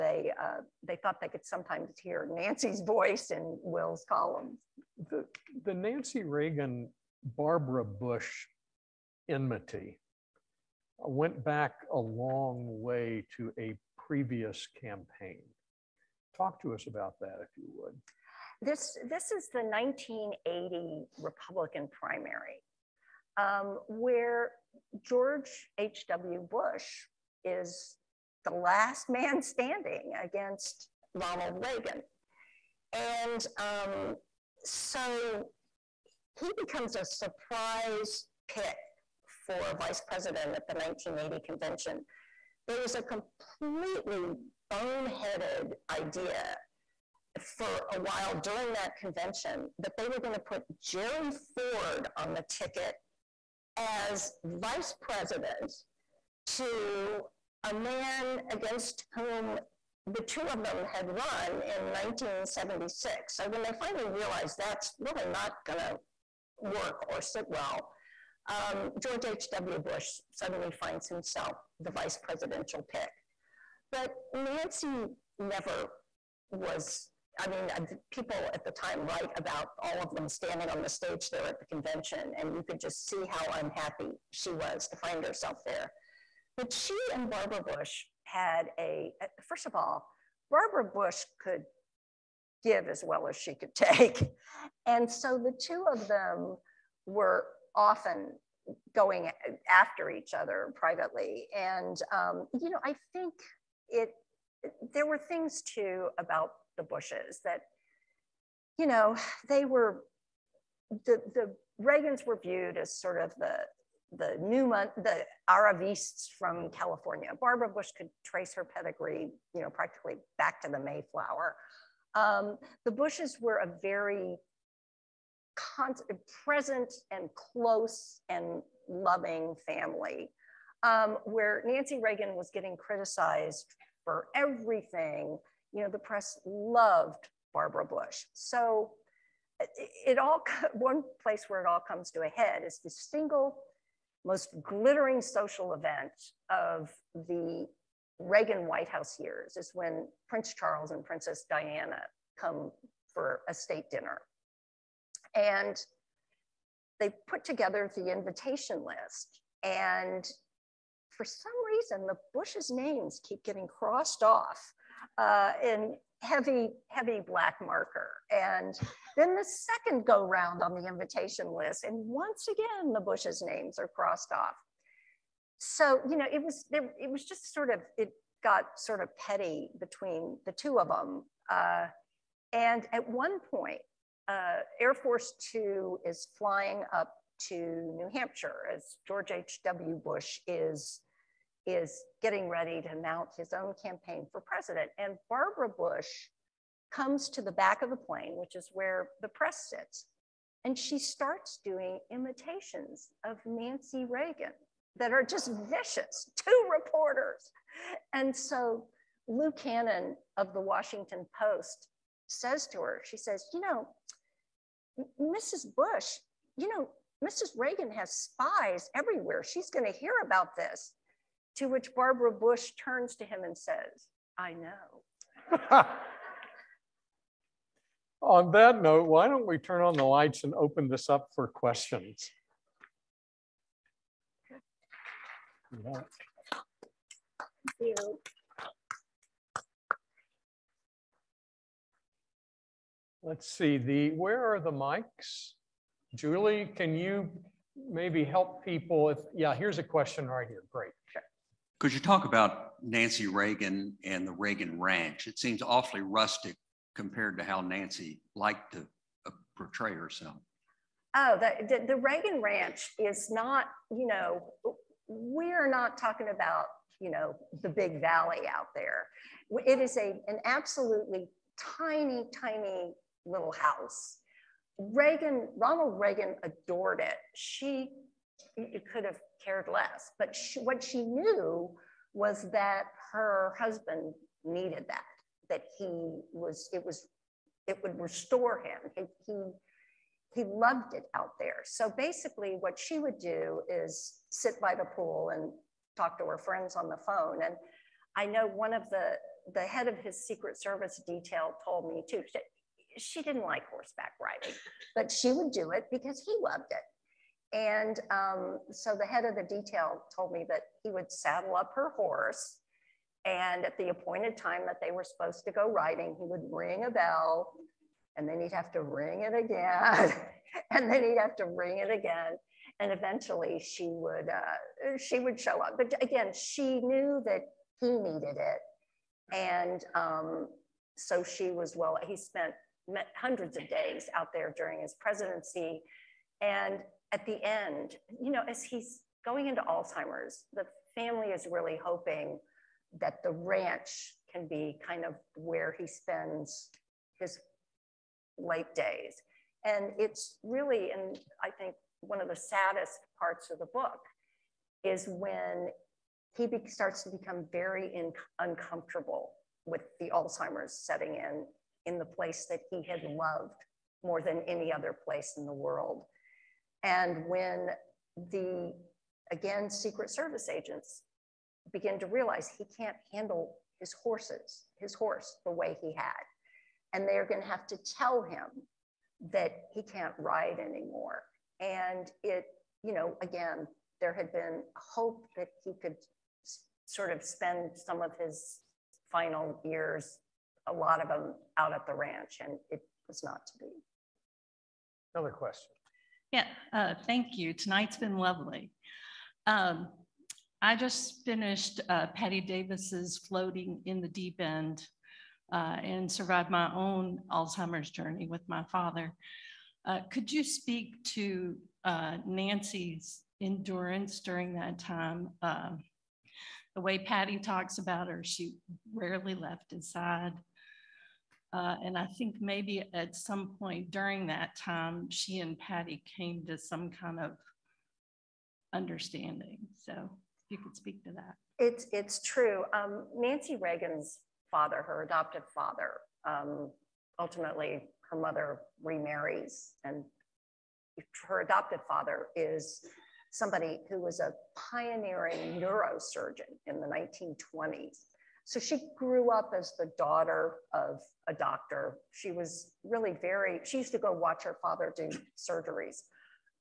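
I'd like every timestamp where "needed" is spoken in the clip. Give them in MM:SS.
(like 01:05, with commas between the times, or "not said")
04:44, 05:27.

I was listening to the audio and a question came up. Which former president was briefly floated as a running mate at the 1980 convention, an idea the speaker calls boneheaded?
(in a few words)
Jerry Ford.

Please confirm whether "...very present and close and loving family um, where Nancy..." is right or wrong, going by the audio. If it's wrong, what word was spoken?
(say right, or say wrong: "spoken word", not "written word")
right.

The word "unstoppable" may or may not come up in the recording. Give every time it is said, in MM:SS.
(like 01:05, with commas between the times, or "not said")
not said.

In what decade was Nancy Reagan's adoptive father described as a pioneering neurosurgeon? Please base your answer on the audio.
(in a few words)
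1920s.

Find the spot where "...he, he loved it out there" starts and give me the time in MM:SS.
04:49.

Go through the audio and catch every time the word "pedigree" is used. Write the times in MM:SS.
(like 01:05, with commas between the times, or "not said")
01:58.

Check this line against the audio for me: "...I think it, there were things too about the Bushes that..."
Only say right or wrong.
right.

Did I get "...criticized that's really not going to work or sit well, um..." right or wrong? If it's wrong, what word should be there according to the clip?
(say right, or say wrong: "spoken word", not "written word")
wrong: "realized", not "criticized".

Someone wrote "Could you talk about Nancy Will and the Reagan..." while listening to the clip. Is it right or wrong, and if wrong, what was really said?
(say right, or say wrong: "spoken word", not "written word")
wrong: "Reagan", not "Will".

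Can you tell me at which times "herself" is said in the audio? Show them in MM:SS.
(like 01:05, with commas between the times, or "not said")
01:25, 04:19.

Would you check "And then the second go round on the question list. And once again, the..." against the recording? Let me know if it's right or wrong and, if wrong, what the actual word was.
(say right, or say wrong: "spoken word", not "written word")
wrong: "invitation", not "question".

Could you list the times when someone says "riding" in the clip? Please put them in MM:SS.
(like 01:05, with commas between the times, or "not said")
05:04, 05:15.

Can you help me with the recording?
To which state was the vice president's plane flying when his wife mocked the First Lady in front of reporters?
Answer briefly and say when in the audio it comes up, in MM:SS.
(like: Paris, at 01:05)
New Hampshire, at 03:07.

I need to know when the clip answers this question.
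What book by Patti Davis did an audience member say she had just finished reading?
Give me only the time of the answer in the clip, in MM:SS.
06:43.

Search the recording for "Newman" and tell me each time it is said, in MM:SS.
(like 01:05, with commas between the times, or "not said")
01:54.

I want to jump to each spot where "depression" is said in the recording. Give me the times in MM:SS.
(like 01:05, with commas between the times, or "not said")
not said.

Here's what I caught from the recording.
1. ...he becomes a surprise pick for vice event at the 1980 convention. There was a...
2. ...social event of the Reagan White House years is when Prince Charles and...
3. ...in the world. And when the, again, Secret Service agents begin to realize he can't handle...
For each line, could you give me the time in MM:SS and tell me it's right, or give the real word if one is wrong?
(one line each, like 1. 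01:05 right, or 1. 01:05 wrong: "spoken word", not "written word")
1. 00:36 wrong: "president", not "event"
2. 02:25 right
3. 06:05 right.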